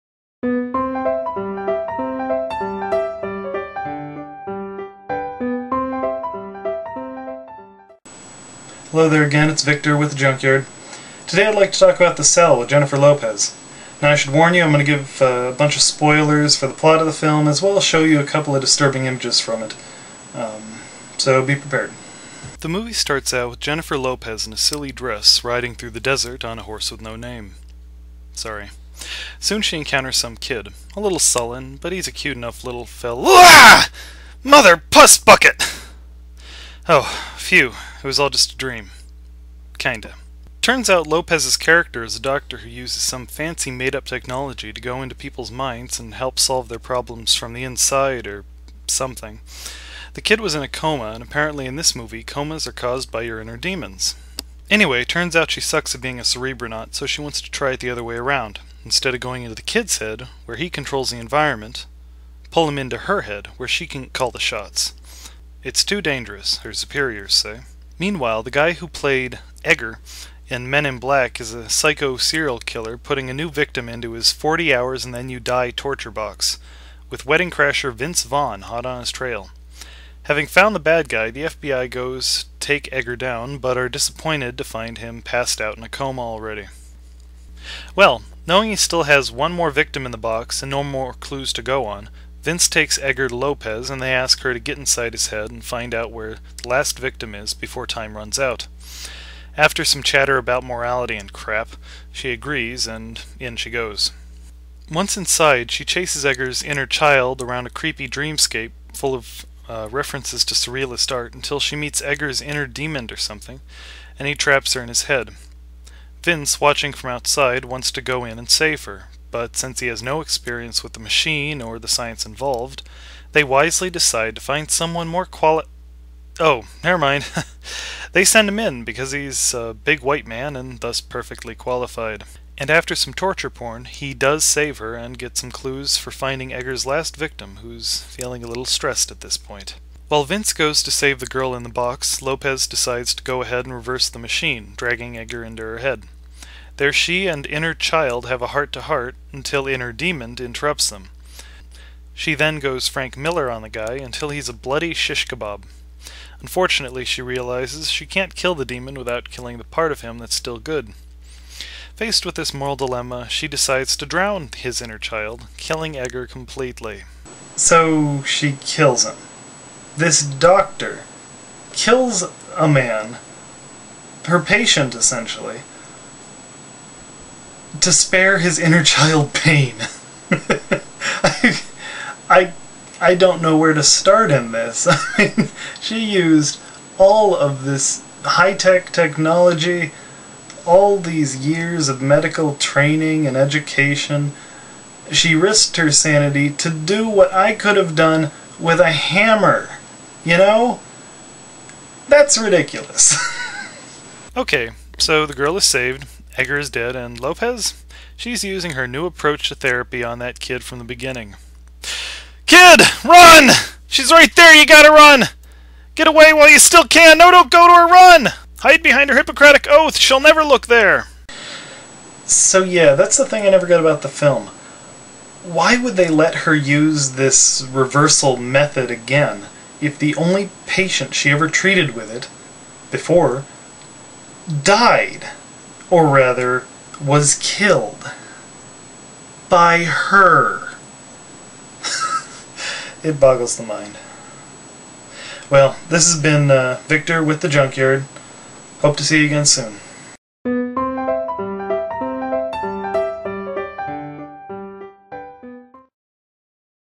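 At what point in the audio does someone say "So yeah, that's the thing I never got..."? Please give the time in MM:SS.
03:42.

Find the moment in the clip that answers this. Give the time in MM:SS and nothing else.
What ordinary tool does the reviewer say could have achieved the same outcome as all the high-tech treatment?
03:18.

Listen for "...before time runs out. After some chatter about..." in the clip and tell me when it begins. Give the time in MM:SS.
01:37.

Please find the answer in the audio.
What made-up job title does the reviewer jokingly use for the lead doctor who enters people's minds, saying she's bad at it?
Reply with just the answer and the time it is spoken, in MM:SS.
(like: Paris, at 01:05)
cerebronaut, at 00:56.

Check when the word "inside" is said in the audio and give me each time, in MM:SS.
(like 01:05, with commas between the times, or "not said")
00:47, 01:34, 01:45.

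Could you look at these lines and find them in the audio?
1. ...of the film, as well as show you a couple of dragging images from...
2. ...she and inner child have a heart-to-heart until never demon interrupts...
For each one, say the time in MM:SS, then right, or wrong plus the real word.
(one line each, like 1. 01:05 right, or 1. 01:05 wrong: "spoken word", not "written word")
1. 00:16 wrong: "disturbing", not "dragging"
2. 02:26 wrong: "inner", not "never".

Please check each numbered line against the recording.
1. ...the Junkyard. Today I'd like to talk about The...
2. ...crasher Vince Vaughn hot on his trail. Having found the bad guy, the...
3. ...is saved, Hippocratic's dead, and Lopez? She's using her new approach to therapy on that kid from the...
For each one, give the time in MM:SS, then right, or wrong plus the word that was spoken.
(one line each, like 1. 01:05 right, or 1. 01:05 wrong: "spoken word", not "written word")
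1. 00:10 right
2. 01:17 right
3. 03:25 wrong: "Edgar", not "Hippocratic".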